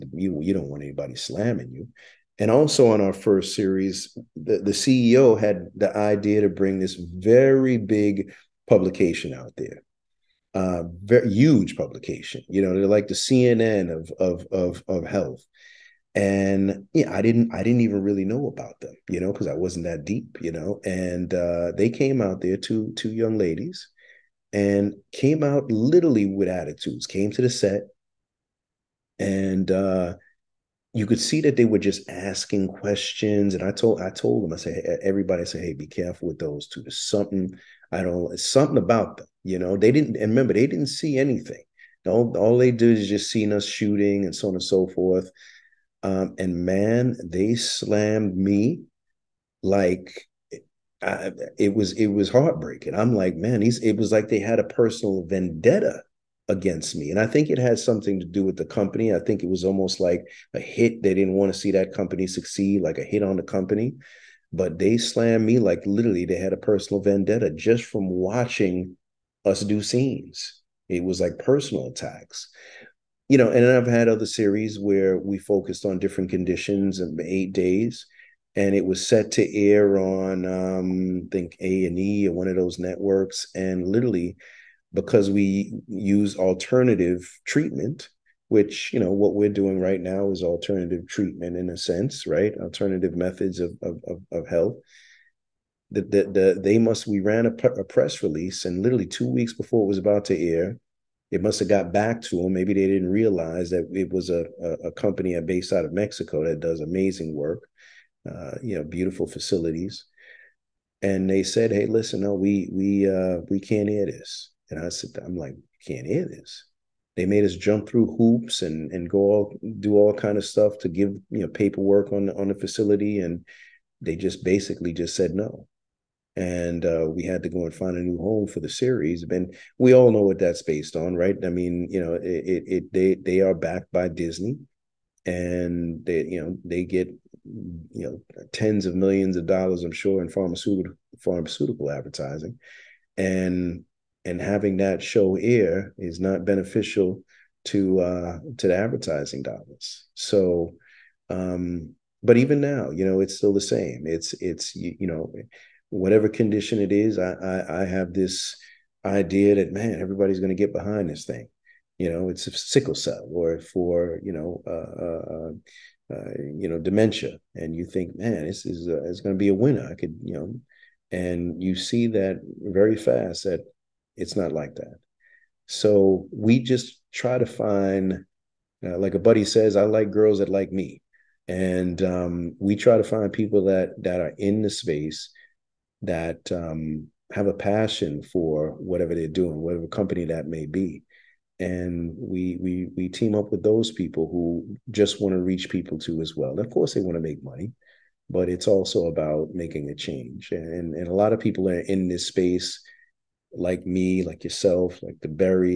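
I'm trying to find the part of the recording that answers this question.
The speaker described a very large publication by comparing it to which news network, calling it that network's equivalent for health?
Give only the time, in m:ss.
0:13.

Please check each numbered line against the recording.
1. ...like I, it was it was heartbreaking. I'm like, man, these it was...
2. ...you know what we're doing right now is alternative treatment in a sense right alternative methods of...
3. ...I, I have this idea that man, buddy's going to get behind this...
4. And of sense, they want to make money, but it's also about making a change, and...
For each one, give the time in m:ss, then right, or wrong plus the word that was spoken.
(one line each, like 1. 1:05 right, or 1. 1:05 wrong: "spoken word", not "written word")
1. 0:49 right
2. 1:28 right
3. 2:37 wrong: "everybody", not "buddy"
4. 3:16 wrong: "course", not "sense".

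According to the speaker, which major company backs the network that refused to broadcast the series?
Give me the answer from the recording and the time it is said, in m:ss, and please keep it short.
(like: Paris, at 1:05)
Disney, at 2:14.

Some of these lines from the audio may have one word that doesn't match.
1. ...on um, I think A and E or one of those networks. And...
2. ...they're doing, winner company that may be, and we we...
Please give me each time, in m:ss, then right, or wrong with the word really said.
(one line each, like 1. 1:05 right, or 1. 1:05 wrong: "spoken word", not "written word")
1. 1:19 right
2. 3:09 wrong: "whatever", not "winner".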